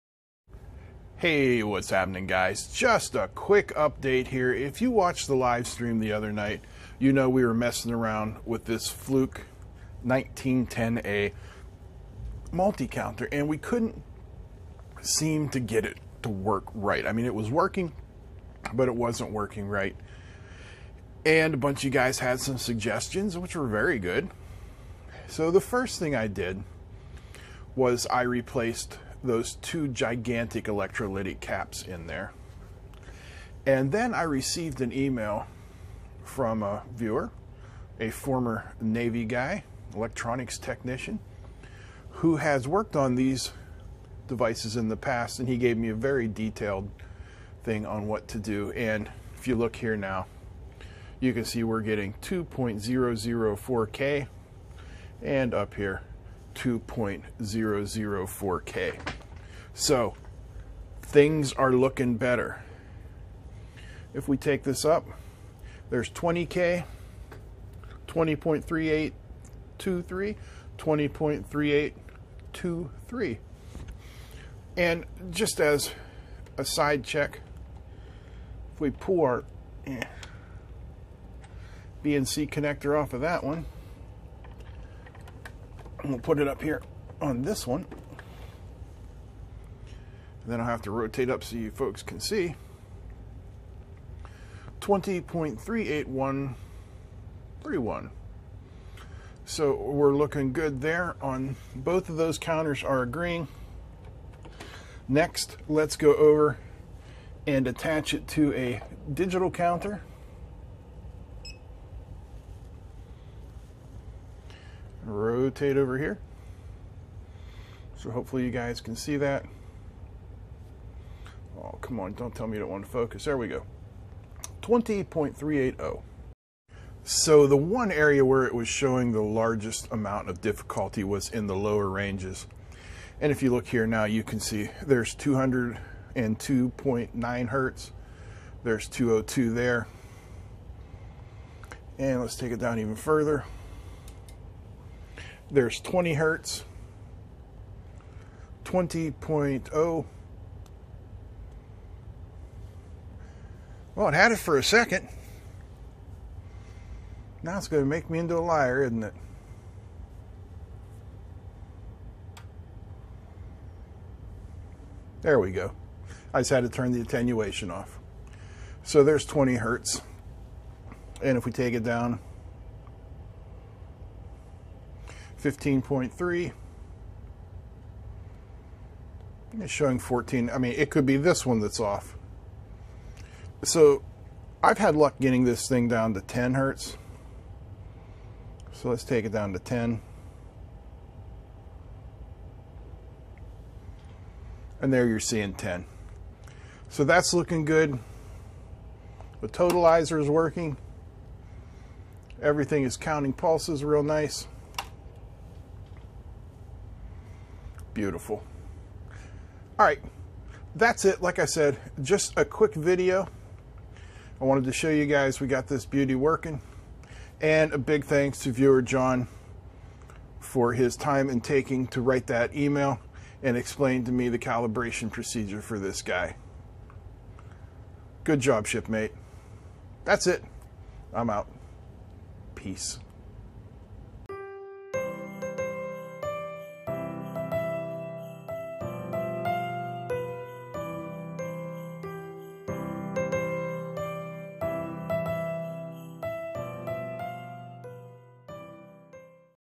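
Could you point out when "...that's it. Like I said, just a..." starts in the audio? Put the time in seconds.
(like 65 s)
210 s.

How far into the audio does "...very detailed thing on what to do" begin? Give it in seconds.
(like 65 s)
45 s.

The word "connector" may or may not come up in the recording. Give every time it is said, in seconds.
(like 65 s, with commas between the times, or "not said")
82 s.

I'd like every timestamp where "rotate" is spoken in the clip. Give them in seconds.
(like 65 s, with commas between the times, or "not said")
90 s, 115 s.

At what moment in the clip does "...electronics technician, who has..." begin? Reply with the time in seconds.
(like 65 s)
39 s.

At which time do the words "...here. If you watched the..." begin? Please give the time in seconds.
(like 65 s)
4 s.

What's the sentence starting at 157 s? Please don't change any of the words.
Now it's going to make me into a liar, isn't it?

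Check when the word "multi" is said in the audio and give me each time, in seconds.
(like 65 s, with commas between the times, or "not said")
12 s.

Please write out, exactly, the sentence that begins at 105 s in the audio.
Next, let's go over and attach it to a digital counter.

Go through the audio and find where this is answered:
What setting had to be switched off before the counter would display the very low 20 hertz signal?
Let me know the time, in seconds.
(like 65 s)
167 s.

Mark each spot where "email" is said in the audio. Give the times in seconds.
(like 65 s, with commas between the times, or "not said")
34 s, 222 s.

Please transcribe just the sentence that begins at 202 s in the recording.
Everything is counting pulses real nice.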